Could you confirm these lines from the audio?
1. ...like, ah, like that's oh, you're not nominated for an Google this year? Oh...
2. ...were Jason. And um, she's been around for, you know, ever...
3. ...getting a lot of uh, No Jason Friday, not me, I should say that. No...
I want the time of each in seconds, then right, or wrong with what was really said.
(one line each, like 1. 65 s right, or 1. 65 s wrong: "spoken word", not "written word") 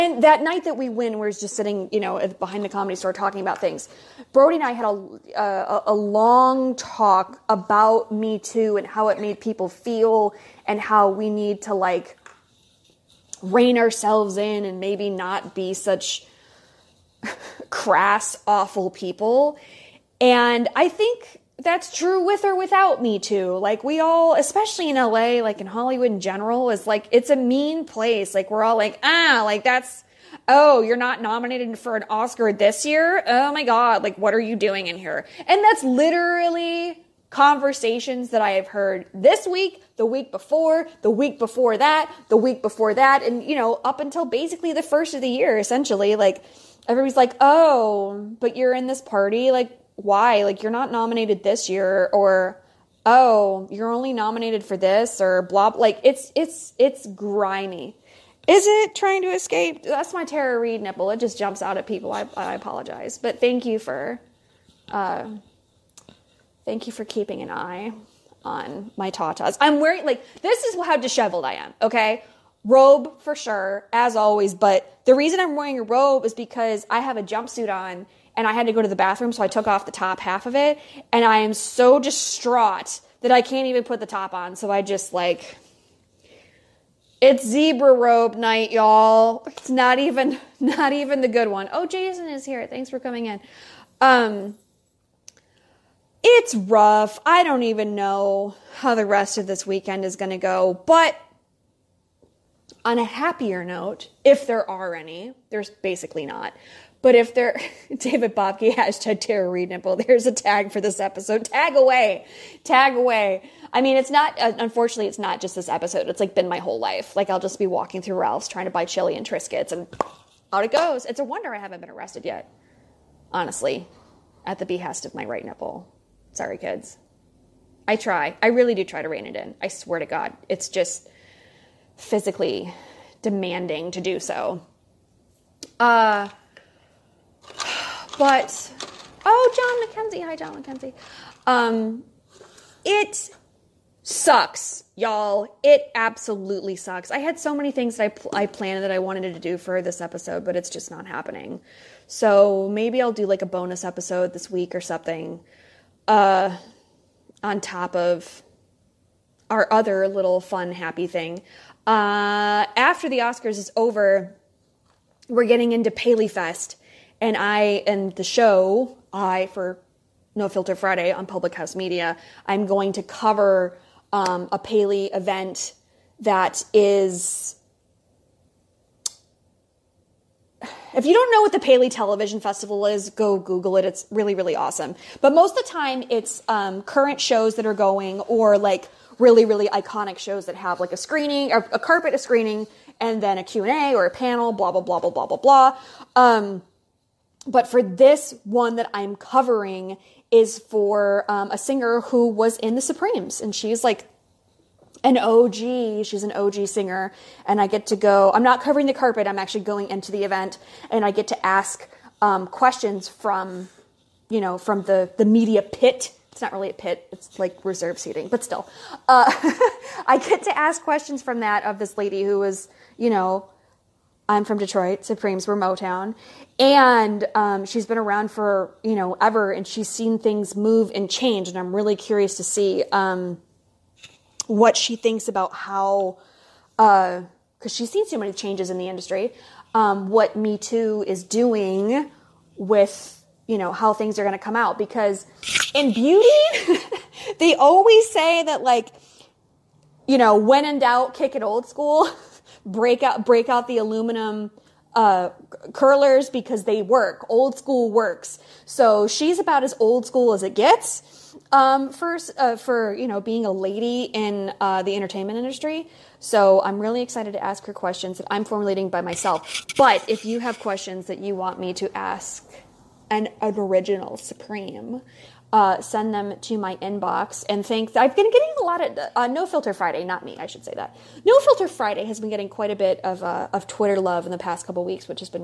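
1. 28 s wrong: "Oscar", not "Google"
2. 225 s wrong: "Motown", not "Jason"
3. 278 s wrong: "Filter", not "Jason".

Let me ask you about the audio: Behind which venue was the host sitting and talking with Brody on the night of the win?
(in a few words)
The Comedy Store.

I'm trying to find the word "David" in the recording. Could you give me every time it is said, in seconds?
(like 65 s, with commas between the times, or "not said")
107 s.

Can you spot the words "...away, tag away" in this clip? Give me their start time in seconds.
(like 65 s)
111 s.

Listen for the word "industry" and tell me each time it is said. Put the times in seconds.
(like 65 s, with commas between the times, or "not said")
238 s, 265 s.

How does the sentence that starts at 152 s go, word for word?
So maybe I'll do like a bonus episode this week or something uh, on top of our other little fun, happy thing.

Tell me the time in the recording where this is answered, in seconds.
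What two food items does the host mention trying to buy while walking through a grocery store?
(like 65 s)
118 s.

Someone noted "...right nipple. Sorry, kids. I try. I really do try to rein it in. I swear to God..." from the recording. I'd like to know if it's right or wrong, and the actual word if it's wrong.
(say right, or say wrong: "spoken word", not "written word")
right.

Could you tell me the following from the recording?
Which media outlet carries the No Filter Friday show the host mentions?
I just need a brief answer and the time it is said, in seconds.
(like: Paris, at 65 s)
Public House Media, at 171 s.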